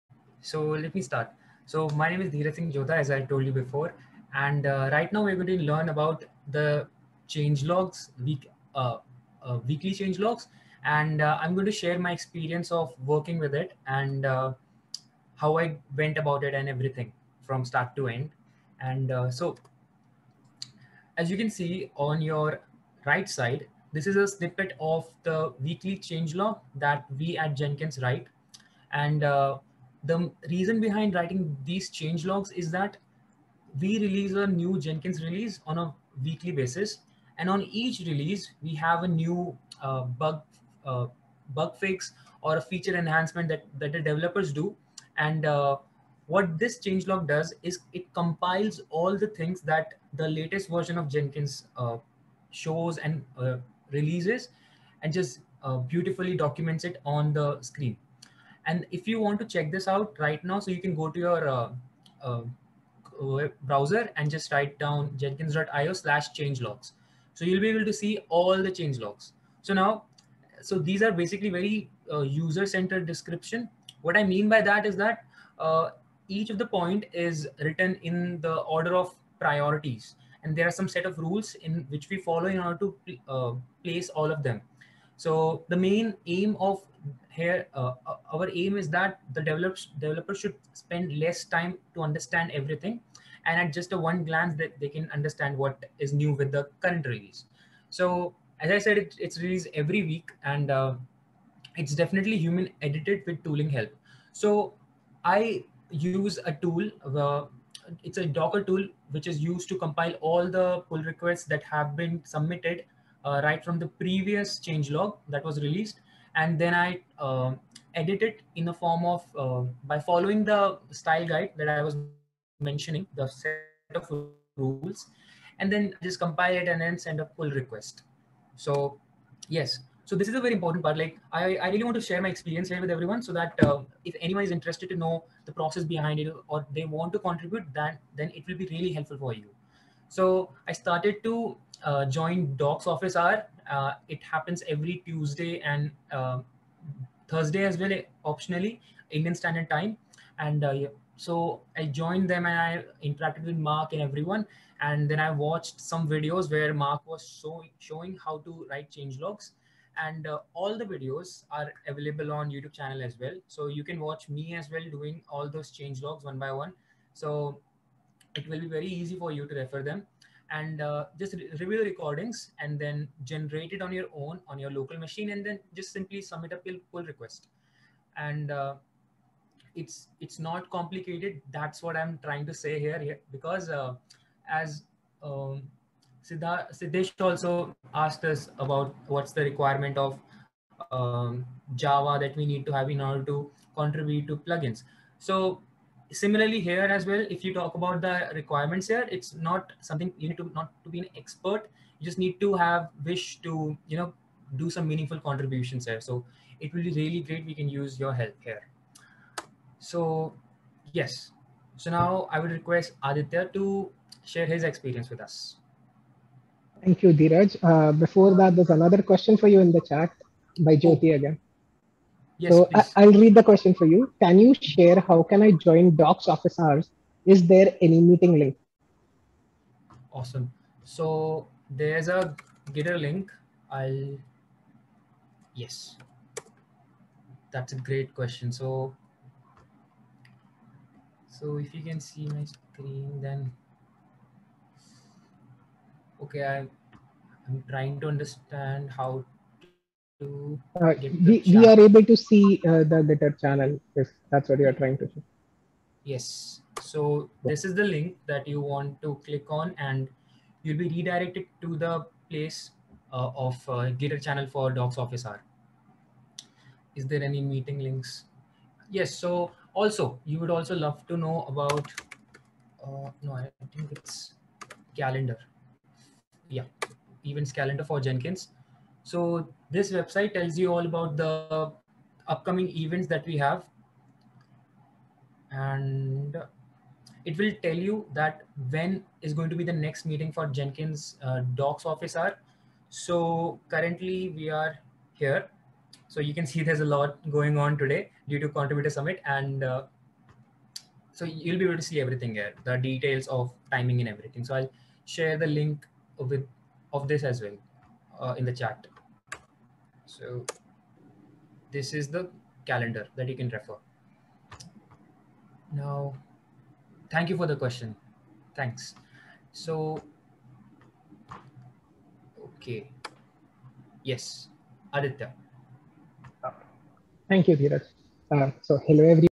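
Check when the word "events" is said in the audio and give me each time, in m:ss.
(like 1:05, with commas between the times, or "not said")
4:37, 4:42.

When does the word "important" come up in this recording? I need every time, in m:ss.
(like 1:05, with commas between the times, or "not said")
2:10.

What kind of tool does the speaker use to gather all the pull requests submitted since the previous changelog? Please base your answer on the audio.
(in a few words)
Docker tool.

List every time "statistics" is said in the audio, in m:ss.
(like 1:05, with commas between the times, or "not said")
not said.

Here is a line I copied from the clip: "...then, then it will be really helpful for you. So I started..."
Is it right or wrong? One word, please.
right.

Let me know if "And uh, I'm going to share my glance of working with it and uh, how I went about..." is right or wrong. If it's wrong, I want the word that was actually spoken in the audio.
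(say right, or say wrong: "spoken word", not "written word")
wrong: "experience", not "glance".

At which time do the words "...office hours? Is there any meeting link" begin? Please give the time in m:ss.
3:46.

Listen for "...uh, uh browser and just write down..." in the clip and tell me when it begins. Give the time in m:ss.
1:02.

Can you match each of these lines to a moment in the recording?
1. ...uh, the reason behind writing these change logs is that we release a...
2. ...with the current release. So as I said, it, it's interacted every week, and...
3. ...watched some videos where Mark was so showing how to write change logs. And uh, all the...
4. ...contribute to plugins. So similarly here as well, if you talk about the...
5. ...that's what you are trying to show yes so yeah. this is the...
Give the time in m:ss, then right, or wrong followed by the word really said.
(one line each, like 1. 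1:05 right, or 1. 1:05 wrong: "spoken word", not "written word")
1. 0:29 right
2. 1:36 wrong: "released", not "interacted"
3. 2:35 right
4. 3:13 right
5. 4:14 right.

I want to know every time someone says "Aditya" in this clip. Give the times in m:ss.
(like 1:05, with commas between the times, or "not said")
3:33, 5:24.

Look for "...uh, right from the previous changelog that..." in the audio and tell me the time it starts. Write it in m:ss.
1:53.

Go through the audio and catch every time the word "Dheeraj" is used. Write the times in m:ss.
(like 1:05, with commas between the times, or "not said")
0:02, 3:37.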